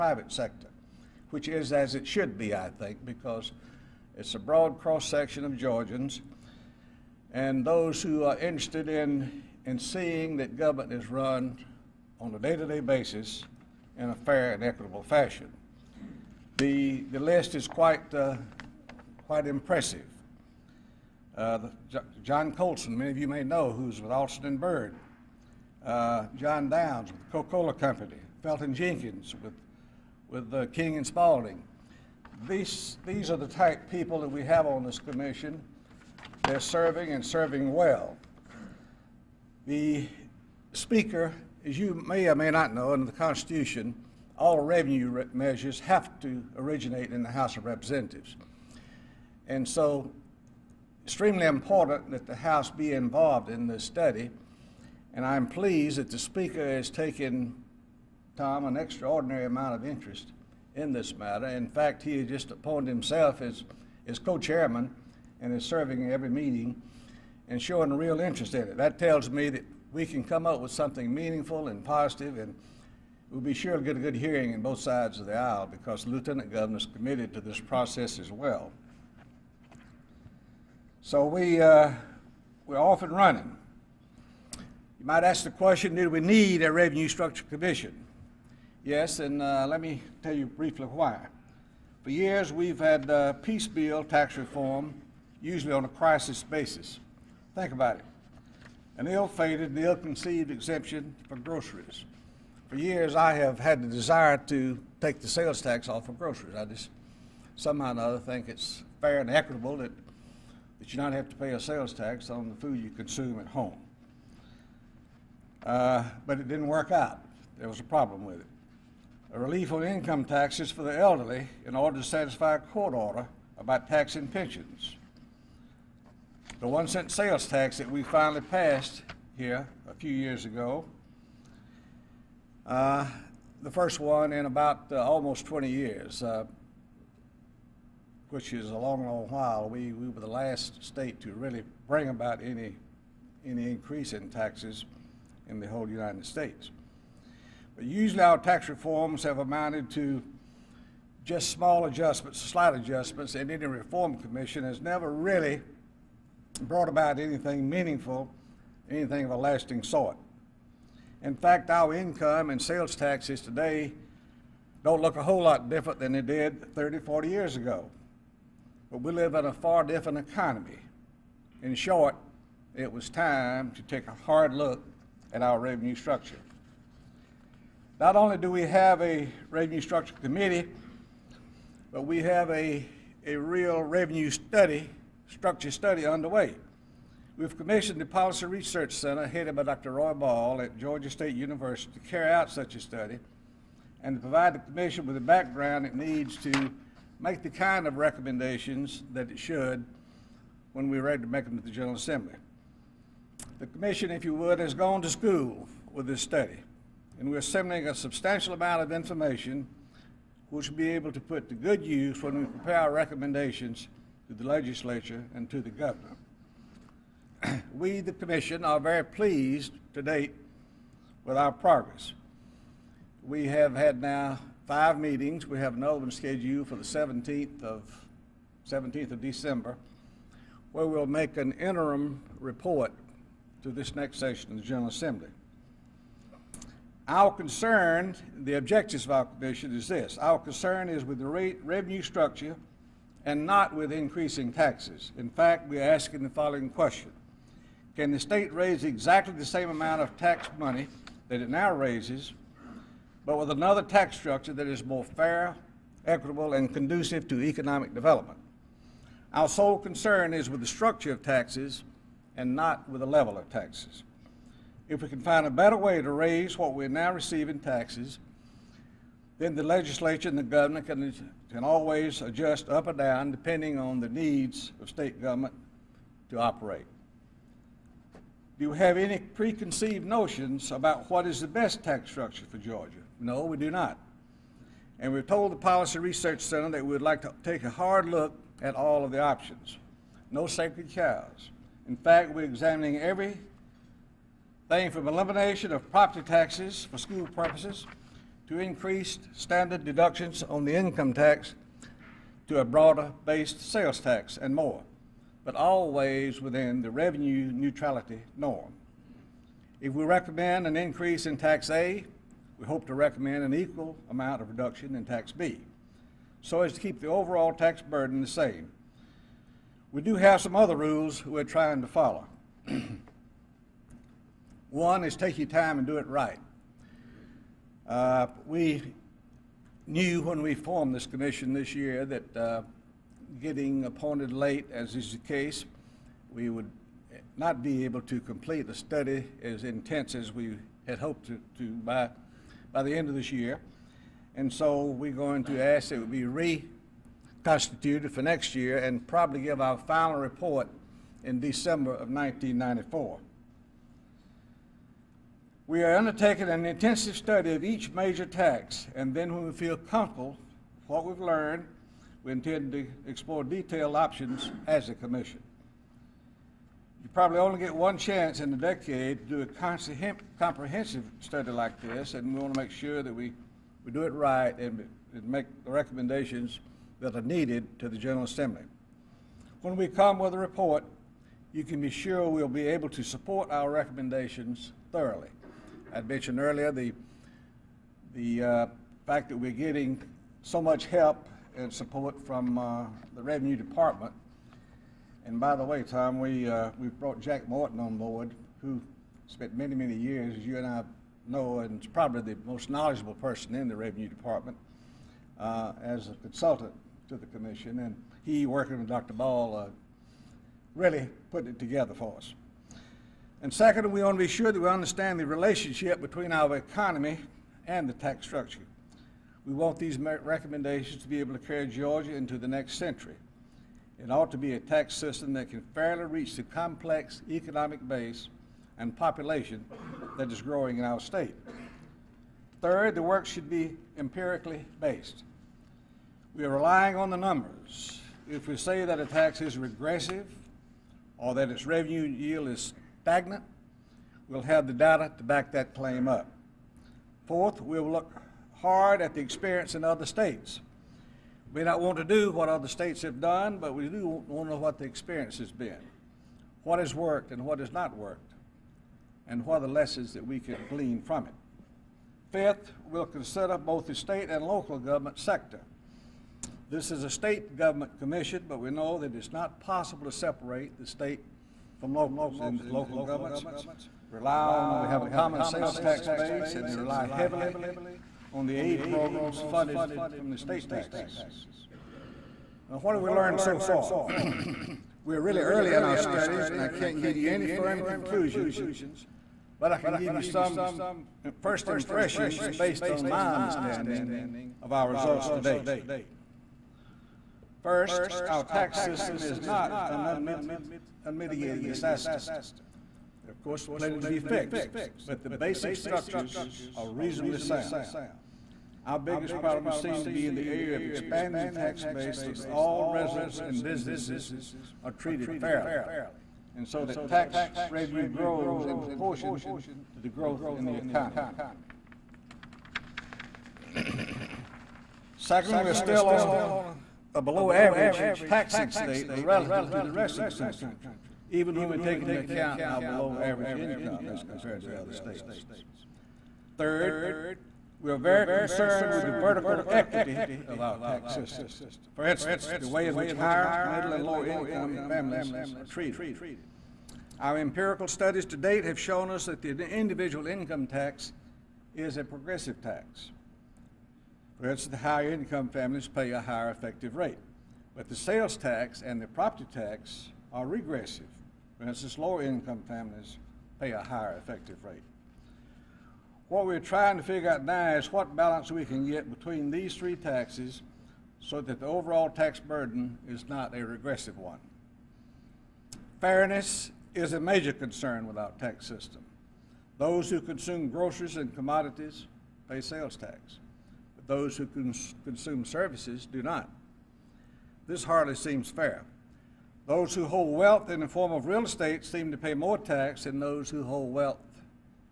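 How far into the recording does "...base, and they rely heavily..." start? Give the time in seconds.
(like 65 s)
476 s.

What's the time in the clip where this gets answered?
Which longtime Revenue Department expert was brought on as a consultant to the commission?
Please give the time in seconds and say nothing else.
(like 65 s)
397 s.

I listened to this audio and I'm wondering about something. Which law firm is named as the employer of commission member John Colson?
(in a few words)
Alston and Bird.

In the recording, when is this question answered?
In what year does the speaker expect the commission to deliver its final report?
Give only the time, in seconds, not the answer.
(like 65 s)
352 s.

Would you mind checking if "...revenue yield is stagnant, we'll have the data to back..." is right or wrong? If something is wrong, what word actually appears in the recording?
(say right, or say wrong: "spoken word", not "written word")
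right.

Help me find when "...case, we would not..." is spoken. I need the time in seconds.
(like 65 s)
335 s.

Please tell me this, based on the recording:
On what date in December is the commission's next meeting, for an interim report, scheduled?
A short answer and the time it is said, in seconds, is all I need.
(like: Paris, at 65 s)
December 17, at 228 s.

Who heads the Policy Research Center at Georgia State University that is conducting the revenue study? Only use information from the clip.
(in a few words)
Dr. Roy Bahl.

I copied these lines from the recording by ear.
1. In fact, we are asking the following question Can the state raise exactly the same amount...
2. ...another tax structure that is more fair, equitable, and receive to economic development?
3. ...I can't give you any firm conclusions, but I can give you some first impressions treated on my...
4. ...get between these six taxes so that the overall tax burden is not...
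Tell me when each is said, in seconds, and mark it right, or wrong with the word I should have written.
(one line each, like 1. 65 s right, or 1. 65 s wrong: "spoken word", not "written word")
1. 245 s right
2. 253 s wrong: "conducive", not "receive"
3. 486 s wrong: "based", not "treated"
4. 568 s wrong: "three", not "six".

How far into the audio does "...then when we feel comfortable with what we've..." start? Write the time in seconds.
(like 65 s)
359 s.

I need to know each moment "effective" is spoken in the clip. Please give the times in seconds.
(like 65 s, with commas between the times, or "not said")
556 s, 564 s.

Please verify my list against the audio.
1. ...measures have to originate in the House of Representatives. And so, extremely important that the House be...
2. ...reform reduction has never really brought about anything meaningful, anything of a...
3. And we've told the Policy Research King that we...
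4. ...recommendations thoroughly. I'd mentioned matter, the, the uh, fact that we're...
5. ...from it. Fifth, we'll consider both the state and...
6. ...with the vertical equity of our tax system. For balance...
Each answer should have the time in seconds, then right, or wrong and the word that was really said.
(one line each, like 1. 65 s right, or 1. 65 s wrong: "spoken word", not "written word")
1. 45 s right
2. 153 s wrong: "commission", not "reduction"
3. 284 s wrong: "Center", not "King"
4. 383 s wrong: "earlier", not "matter"
5. 461 s right
6. 538 s wrong: "instance", not "balance".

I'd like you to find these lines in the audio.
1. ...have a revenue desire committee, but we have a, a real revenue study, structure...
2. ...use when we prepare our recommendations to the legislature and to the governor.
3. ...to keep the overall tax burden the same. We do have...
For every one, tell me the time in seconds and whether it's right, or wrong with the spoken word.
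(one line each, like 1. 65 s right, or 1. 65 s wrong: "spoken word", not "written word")
1. 178 s wrong: "structure", not "desire"
2. 211 s right
3. 316 s right.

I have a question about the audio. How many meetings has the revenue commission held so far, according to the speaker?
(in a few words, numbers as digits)
5.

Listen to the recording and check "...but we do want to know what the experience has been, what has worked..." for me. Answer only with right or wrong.
right.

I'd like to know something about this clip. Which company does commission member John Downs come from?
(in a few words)
Coca Cola Company.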